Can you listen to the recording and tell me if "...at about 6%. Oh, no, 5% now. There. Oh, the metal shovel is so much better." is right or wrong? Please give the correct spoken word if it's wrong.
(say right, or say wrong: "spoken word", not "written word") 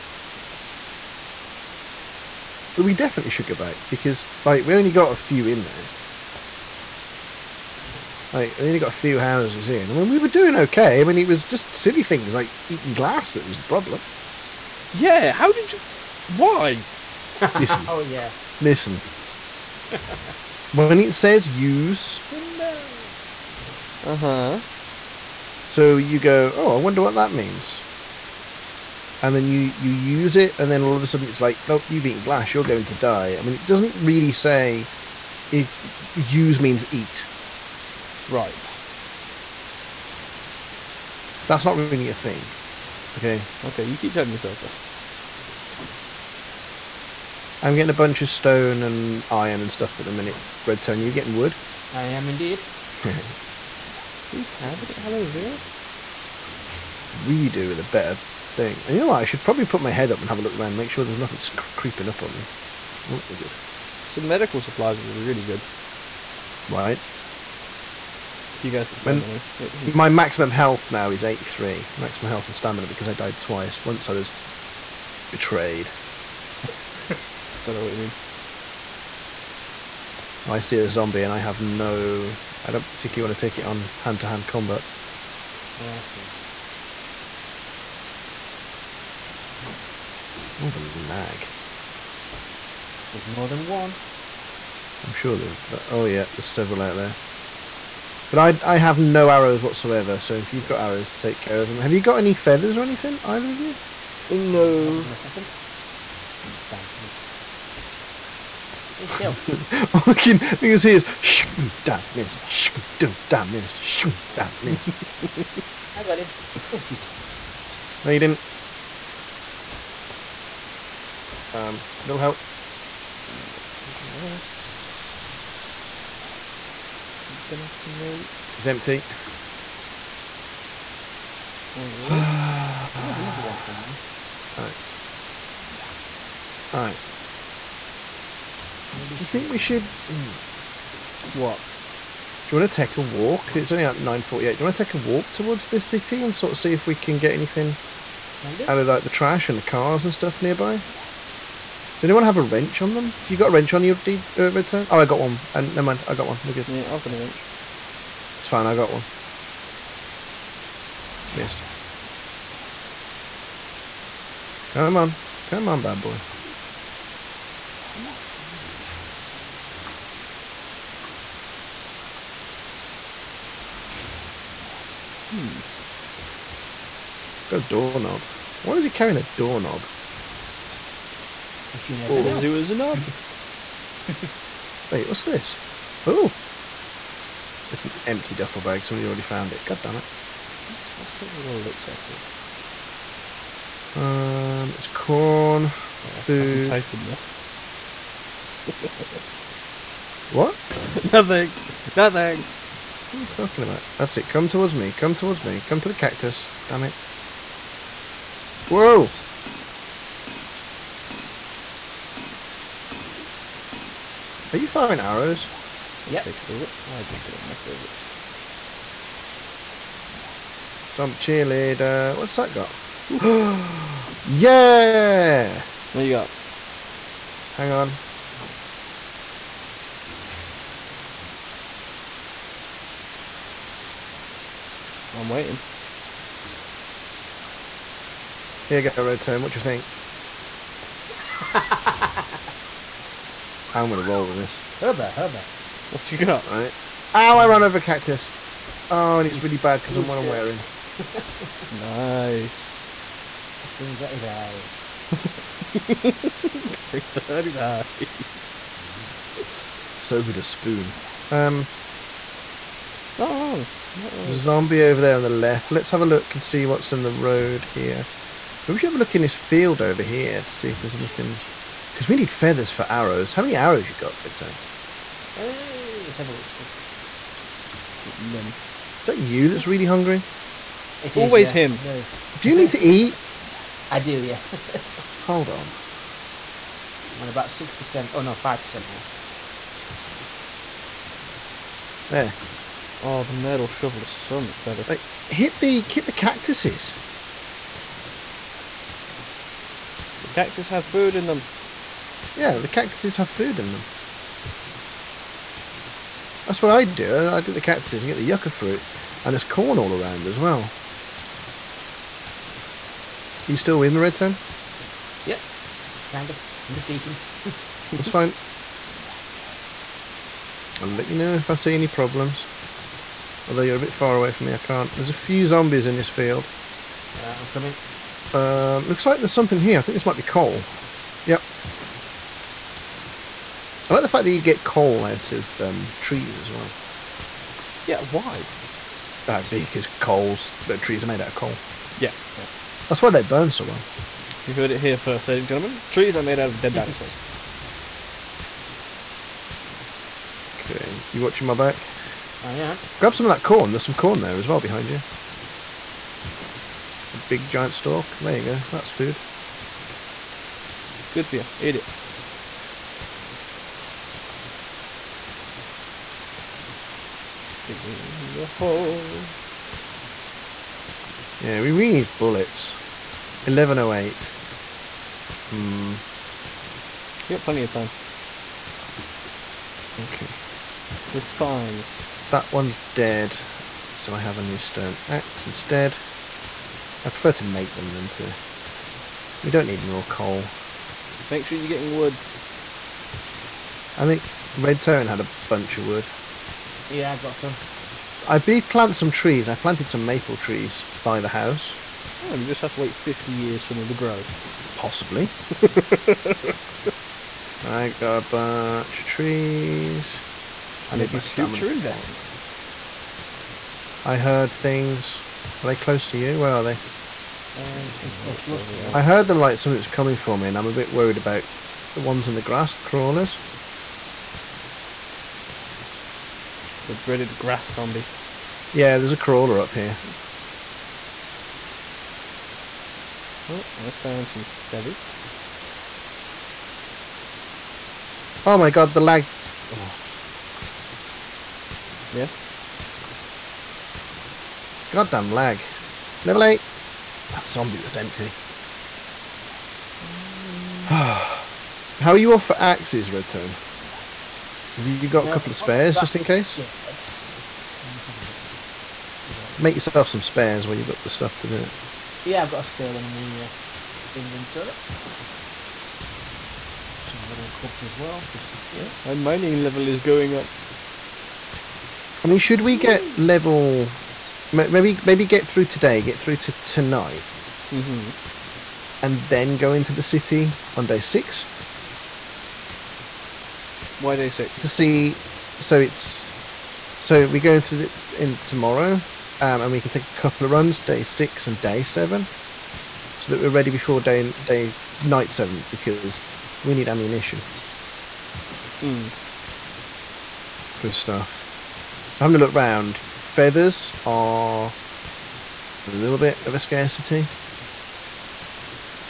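right.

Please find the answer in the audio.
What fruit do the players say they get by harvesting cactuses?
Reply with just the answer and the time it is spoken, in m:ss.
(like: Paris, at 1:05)
Yucca fruit, at 5:08.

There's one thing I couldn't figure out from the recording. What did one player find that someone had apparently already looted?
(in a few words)
Empty duffel bag.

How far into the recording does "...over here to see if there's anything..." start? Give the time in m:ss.
4:29.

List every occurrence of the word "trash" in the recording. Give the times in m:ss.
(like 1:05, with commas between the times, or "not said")
2:29.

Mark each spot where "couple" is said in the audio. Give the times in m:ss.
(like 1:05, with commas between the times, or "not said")
7:35, 8:10.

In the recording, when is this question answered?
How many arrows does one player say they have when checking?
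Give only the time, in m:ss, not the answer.
4:38.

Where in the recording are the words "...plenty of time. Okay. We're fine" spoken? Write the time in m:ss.
6:17.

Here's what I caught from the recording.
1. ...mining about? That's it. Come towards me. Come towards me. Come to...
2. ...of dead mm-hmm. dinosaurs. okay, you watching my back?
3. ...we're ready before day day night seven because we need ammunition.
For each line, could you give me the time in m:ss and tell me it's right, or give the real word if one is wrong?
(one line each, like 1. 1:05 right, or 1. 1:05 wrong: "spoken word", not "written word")
1. 3:23 wrong: "talking", not "mining"
2. 5:46 right
3. 8:13 right.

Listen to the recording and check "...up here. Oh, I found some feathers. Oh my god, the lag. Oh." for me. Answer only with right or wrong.
right.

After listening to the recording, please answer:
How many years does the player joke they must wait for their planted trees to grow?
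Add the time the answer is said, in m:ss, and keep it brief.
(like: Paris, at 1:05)
50, at 6:42.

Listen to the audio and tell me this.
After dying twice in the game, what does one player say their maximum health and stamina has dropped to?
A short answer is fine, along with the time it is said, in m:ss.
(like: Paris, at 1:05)
83, at 1:11.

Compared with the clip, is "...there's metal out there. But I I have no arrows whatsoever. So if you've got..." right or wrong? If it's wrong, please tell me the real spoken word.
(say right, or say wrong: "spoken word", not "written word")
wrong: "several", not "metal".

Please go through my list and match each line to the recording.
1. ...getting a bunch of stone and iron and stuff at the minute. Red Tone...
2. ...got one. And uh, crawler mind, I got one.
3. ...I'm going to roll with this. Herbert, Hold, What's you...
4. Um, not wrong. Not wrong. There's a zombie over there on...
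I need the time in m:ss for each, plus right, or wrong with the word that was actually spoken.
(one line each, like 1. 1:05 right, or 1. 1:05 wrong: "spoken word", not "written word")
1. 0:47 right
2. 2:35 wrong: "never", not "crawler"
3. 4:03 wrong: "Herbert", not "Hold"
4. 4:21 right.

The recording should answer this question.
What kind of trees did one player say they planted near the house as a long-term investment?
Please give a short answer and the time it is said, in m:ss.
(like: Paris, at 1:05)
Maple trees, at 6:40.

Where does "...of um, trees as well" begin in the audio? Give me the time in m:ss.
5:35.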